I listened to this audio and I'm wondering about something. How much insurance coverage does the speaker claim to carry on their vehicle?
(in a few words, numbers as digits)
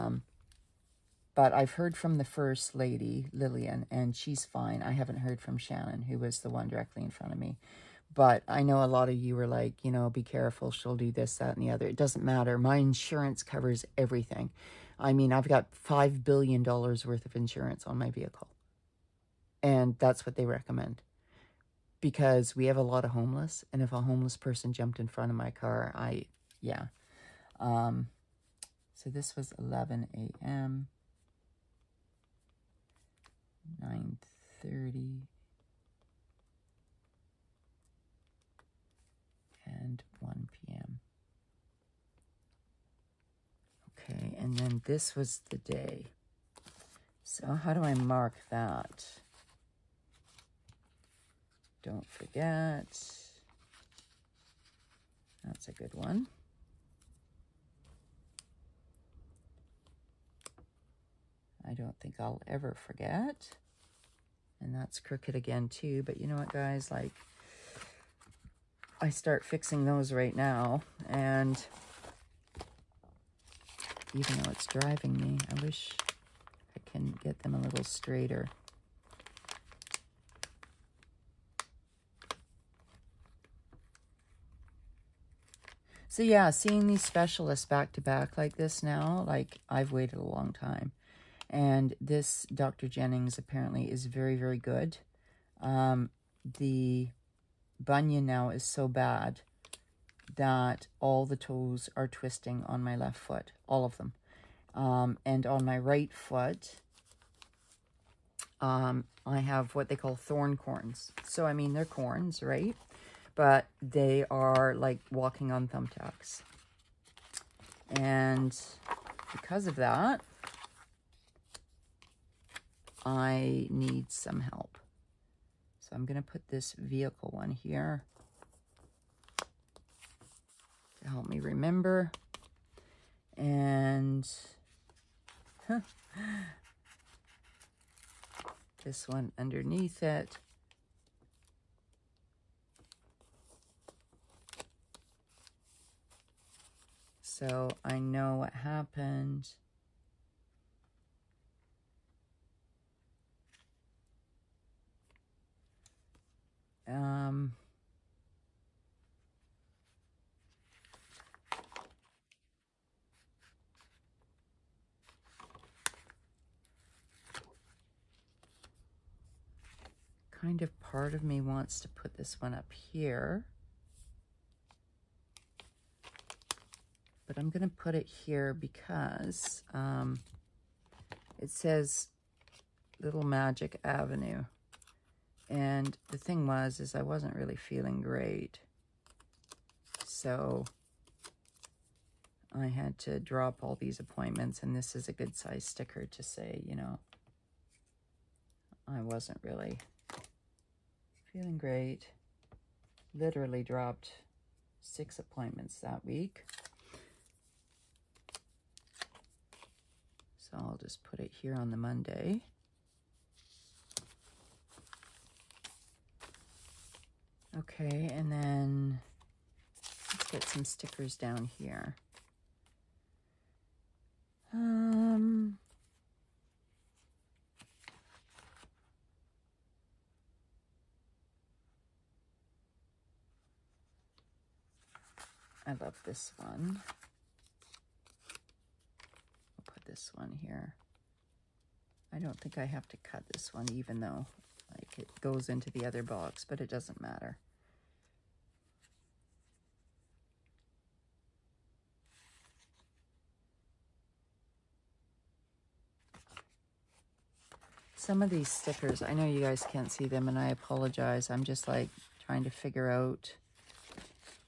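$5 billion.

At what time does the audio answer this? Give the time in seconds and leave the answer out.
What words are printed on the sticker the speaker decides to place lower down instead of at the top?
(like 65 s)
182 s.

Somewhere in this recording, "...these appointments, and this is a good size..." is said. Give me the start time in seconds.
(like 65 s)
193 s.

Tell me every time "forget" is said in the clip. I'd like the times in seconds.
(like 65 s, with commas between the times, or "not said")
52 s, 62 s.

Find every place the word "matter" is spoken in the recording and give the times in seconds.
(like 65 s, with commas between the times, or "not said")
12 s, 247 s.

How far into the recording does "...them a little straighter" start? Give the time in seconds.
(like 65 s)
77 s.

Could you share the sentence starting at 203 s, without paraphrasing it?
Literally dropped six appointments that week.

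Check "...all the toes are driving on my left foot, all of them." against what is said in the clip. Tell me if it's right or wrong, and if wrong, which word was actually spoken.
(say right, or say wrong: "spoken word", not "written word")
wrong: "twisting", not "driving".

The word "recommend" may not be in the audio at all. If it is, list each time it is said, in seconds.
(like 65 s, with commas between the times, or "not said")
20 s.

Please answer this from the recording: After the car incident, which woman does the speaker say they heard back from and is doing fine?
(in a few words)
Lillian.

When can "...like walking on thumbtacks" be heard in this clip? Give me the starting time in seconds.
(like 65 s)
114 s.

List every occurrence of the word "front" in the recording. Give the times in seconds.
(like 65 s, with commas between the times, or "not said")
7 s, 25 s.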